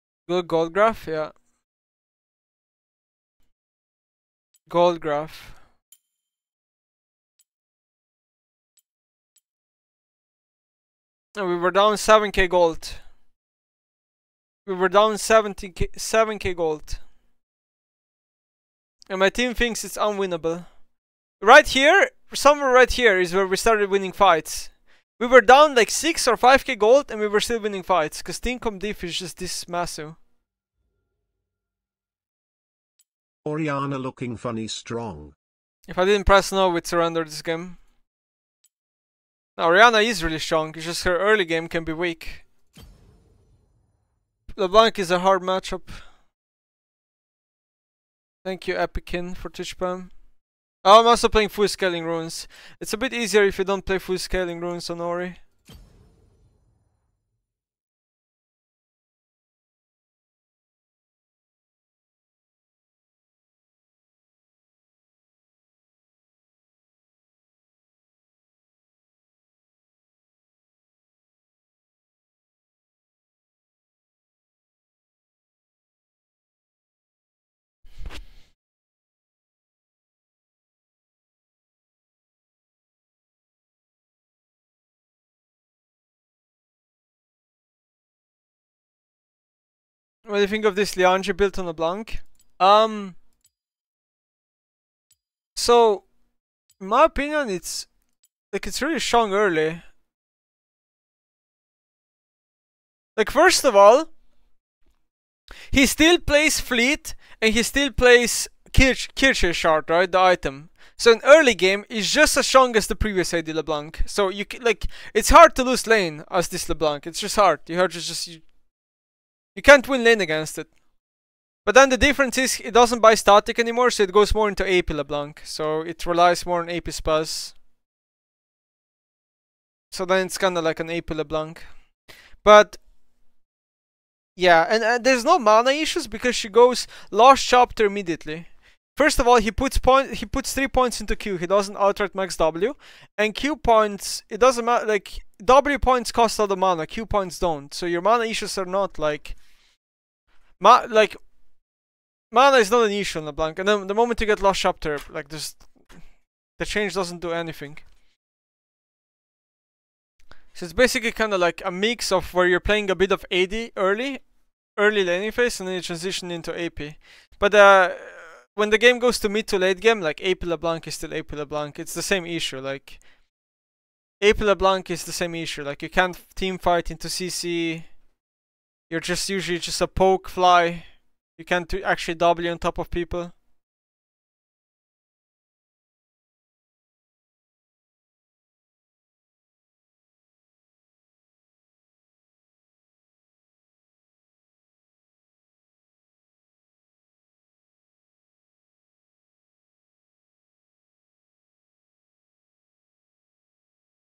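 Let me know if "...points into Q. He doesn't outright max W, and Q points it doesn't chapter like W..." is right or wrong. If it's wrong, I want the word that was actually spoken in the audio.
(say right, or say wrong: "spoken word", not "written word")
wrong: "matter", not "chapter".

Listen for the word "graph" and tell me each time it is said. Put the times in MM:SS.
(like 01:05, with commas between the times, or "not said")
00:00, 00:05.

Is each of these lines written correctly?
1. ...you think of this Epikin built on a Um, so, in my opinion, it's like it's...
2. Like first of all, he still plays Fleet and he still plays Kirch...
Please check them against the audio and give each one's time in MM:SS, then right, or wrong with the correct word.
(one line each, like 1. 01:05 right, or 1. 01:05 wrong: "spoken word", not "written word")
1. 01:30 wrong: "Liange", not "Epikin"
2. 01:43 right.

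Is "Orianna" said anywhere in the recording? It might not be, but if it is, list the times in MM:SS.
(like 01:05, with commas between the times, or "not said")
00:33, 00:39.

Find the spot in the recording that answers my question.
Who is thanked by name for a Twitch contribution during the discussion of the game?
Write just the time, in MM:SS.
00:48.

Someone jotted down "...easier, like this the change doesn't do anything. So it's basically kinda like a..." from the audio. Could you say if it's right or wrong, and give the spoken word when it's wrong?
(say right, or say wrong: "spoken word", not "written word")
wrong: "chapter", not "easier".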